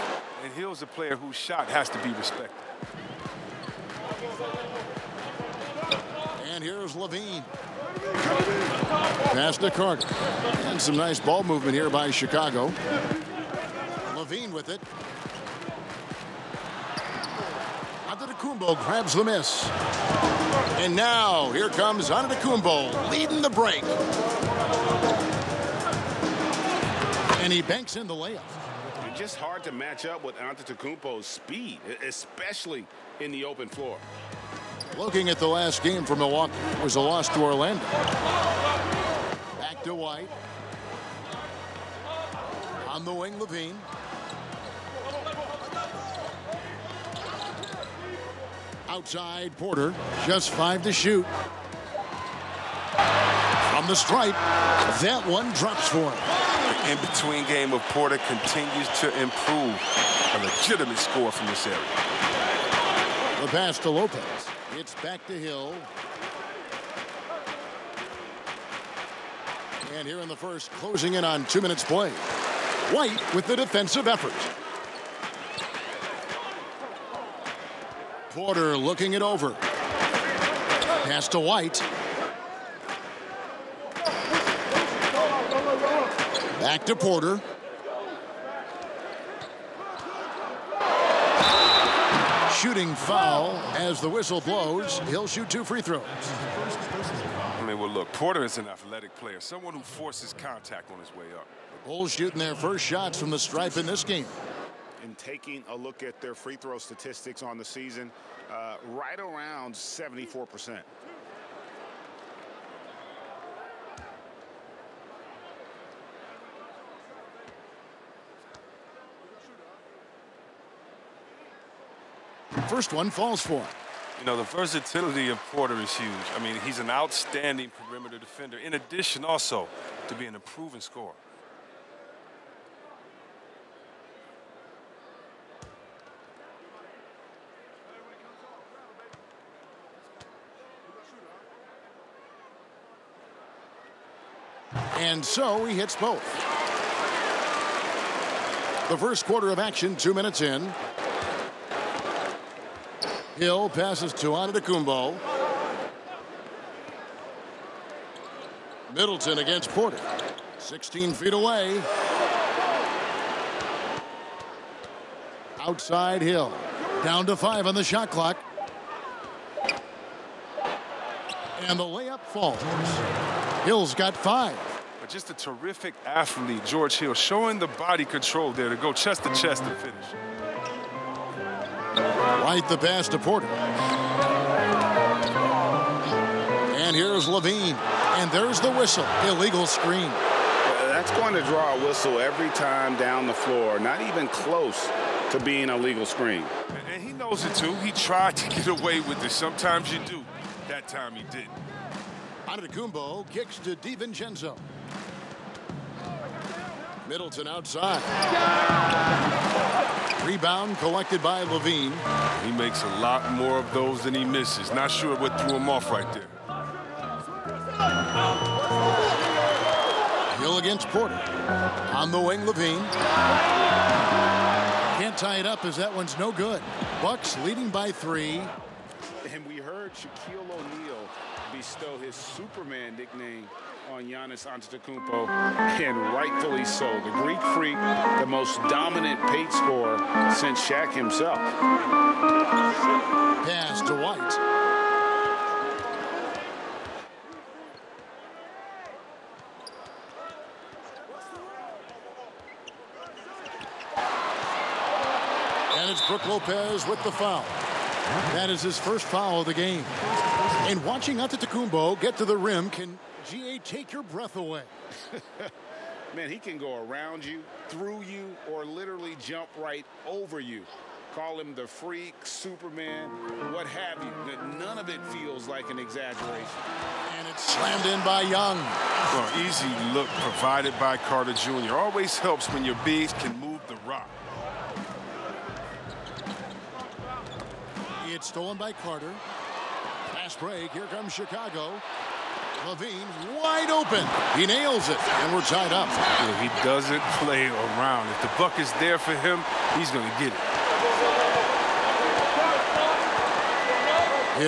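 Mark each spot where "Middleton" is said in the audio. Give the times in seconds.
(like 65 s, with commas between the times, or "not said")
158 s, 207 s.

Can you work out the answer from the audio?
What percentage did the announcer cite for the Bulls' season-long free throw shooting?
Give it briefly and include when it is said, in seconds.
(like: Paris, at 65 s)
74%, at 109 s.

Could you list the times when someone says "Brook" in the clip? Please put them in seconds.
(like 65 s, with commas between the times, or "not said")
256 s.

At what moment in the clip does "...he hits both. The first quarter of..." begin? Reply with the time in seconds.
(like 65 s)
145 s.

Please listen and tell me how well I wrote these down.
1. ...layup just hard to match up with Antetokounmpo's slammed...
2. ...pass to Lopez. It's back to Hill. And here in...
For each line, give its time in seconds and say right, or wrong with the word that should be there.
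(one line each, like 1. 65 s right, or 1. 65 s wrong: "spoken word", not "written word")
1. 28 s wrong: "speed", not "slammed"
2. 63 s right.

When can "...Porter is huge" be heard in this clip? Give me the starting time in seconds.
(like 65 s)
125 s.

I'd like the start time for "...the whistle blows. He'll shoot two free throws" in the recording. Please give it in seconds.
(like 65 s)
94 s.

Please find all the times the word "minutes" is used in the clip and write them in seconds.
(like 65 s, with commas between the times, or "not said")
71 s, 150 s.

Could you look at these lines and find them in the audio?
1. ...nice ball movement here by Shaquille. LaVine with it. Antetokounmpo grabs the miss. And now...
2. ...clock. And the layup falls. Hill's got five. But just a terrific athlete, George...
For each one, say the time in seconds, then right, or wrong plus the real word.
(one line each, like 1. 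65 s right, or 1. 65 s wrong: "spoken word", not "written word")
1. 10 s wrong: "Chicago", not "Shaquille"
2. 168 s right.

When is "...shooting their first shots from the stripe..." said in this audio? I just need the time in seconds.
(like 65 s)
102 s.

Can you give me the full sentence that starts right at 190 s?
That's going to draw a whistle every time down the floor.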